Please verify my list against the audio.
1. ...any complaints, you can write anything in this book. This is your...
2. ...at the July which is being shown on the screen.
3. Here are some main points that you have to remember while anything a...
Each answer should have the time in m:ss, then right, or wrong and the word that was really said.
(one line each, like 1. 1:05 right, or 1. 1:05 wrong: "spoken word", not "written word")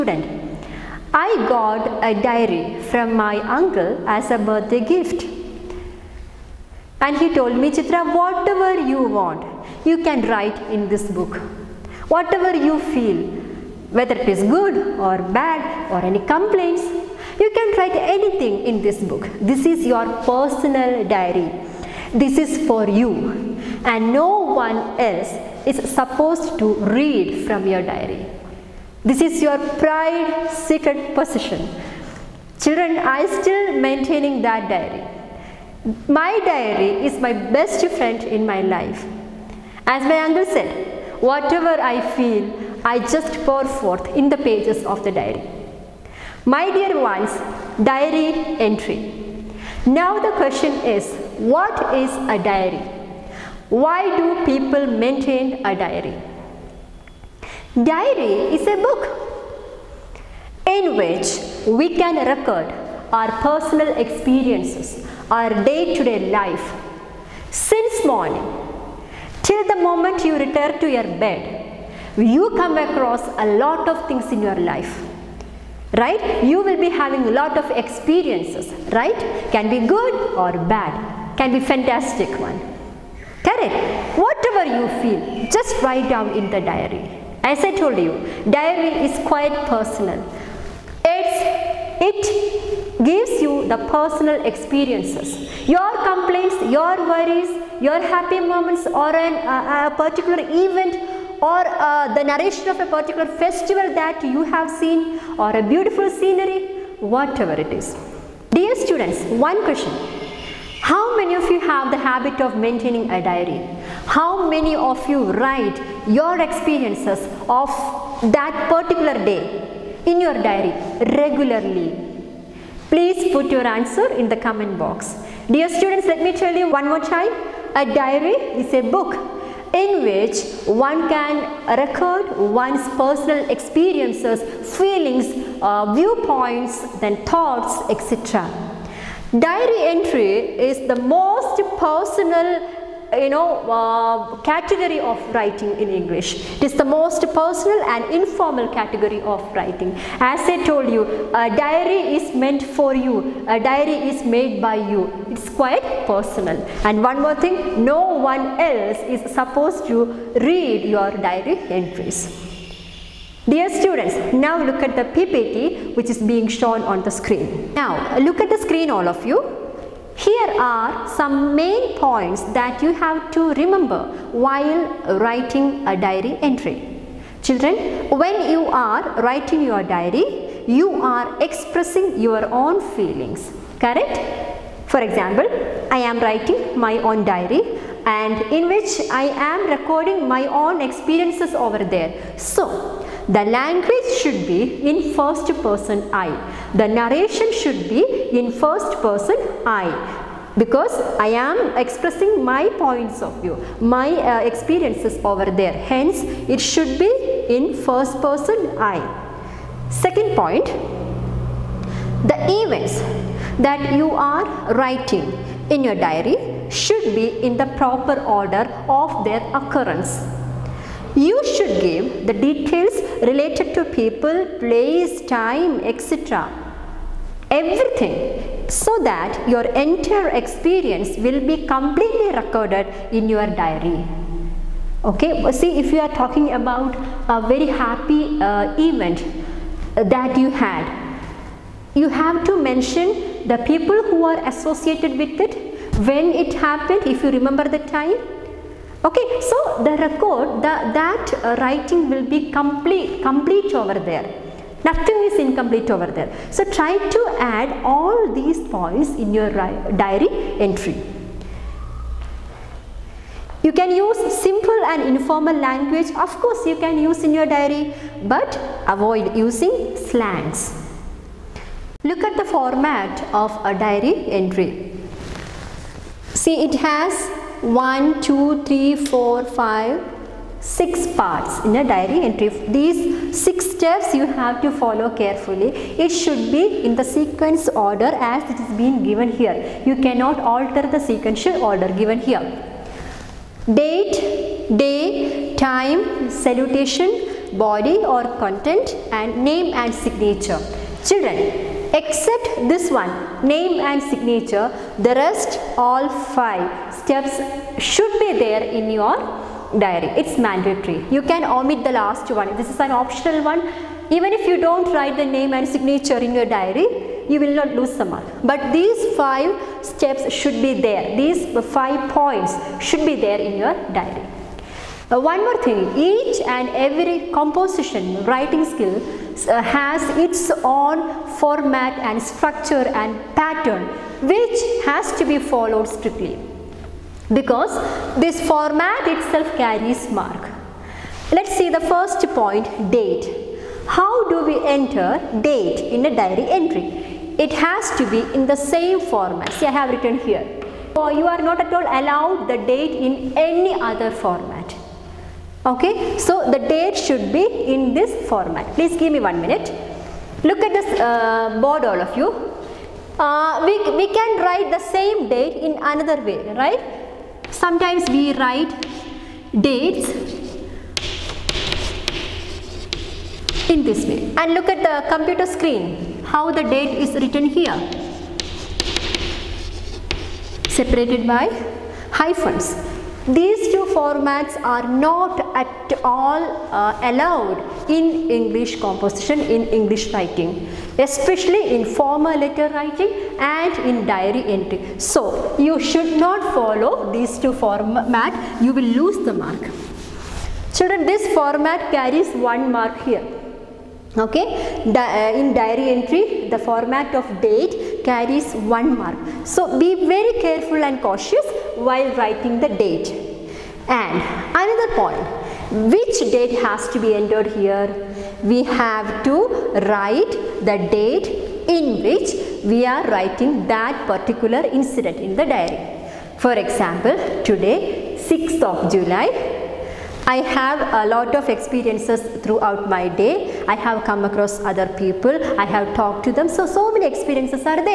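1. 0:16 right
2. 2:44 wrong: "PPT", not "July"
3. 2:50 wrong: "writing", not "anything".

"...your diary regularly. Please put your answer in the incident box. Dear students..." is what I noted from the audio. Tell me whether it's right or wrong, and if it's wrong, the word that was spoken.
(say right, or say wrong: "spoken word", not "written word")
wrong: "comment", not "incident".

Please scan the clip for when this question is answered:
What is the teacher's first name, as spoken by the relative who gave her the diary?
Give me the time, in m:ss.
0:07.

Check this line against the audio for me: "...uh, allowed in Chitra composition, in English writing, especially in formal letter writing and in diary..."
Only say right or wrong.
wrong.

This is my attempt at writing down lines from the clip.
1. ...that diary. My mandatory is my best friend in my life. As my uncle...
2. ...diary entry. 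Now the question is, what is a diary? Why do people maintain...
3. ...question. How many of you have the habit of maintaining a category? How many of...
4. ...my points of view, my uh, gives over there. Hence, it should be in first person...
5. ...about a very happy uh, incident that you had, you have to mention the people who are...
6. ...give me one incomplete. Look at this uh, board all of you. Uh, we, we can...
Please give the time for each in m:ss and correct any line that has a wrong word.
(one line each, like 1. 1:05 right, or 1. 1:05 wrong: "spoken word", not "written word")
1. 0:34 wrong: "diary", not "mandatory"
2. 0:47 right
3. 1:49 wrong: "diary", not "category"
4. 3:22 wrong: "experiences", not "gives"
5. 3:56 wrong: "event", not "incident"
6. 5:58 wrong: "minute", not "incomplete".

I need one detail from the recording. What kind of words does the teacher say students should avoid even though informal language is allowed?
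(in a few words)
Slangs.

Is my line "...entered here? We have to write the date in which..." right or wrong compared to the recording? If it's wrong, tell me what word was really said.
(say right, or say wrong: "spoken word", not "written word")
right.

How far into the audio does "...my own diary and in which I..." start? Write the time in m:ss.
3:06.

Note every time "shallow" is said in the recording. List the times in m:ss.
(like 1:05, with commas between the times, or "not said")
not said.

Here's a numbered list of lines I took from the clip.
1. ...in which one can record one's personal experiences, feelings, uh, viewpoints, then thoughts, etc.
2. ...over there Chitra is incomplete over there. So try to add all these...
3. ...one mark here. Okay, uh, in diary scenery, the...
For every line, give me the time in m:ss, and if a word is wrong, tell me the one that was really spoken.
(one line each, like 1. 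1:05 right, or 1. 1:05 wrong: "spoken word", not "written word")
1. 2:09 right
2. 4:13 wrong: "Nothing", not "Chitra"
3. 6:42 wrong: "entry", not "scenery".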